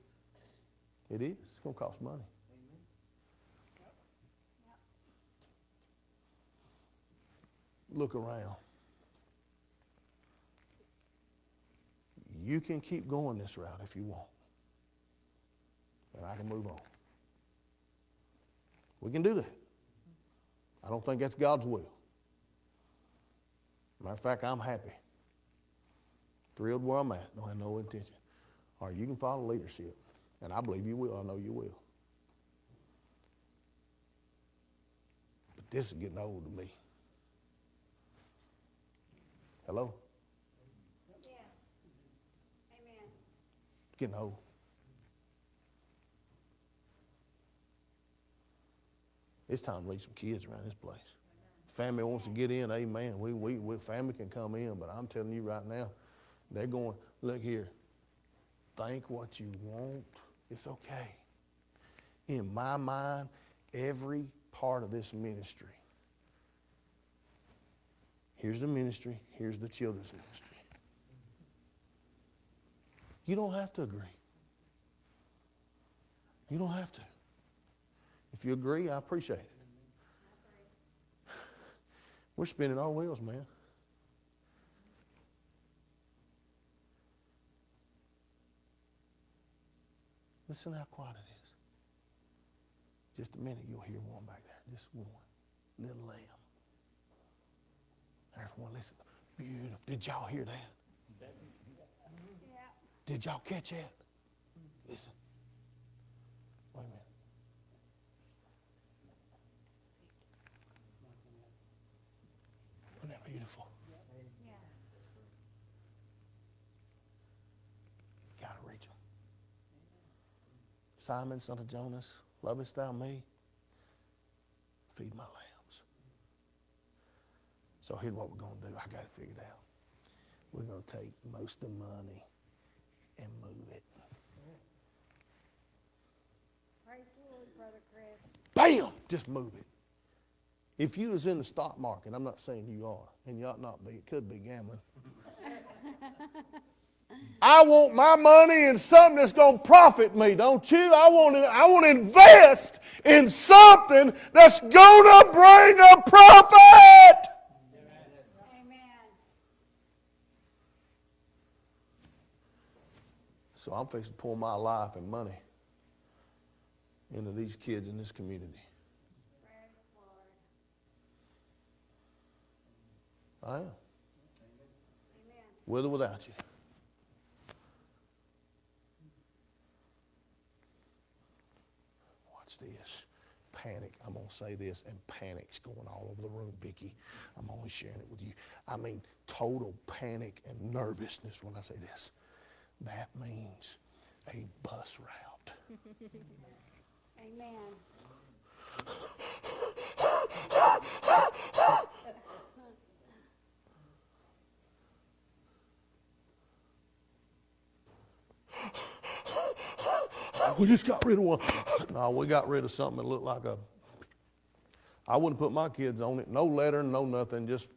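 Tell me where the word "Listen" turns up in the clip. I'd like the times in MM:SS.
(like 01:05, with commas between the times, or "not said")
01:30, 01:38, 01:44.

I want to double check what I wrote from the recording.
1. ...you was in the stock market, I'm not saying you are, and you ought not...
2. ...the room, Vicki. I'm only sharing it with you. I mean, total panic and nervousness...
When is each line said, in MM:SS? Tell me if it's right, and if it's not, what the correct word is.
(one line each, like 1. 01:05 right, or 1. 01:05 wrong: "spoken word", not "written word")
1. 02:20 right
2. 03:06 right.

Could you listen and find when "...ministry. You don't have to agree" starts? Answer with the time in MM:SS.
01:10.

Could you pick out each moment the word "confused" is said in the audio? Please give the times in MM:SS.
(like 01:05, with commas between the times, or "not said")
not said.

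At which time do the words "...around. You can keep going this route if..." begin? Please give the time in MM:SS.
00:08.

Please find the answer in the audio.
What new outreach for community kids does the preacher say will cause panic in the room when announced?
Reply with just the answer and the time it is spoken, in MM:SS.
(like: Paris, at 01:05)
A bus route, at 03:14.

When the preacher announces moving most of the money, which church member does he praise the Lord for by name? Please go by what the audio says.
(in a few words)
Brother Chris.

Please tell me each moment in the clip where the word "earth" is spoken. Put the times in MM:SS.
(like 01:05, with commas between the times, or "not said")
not said.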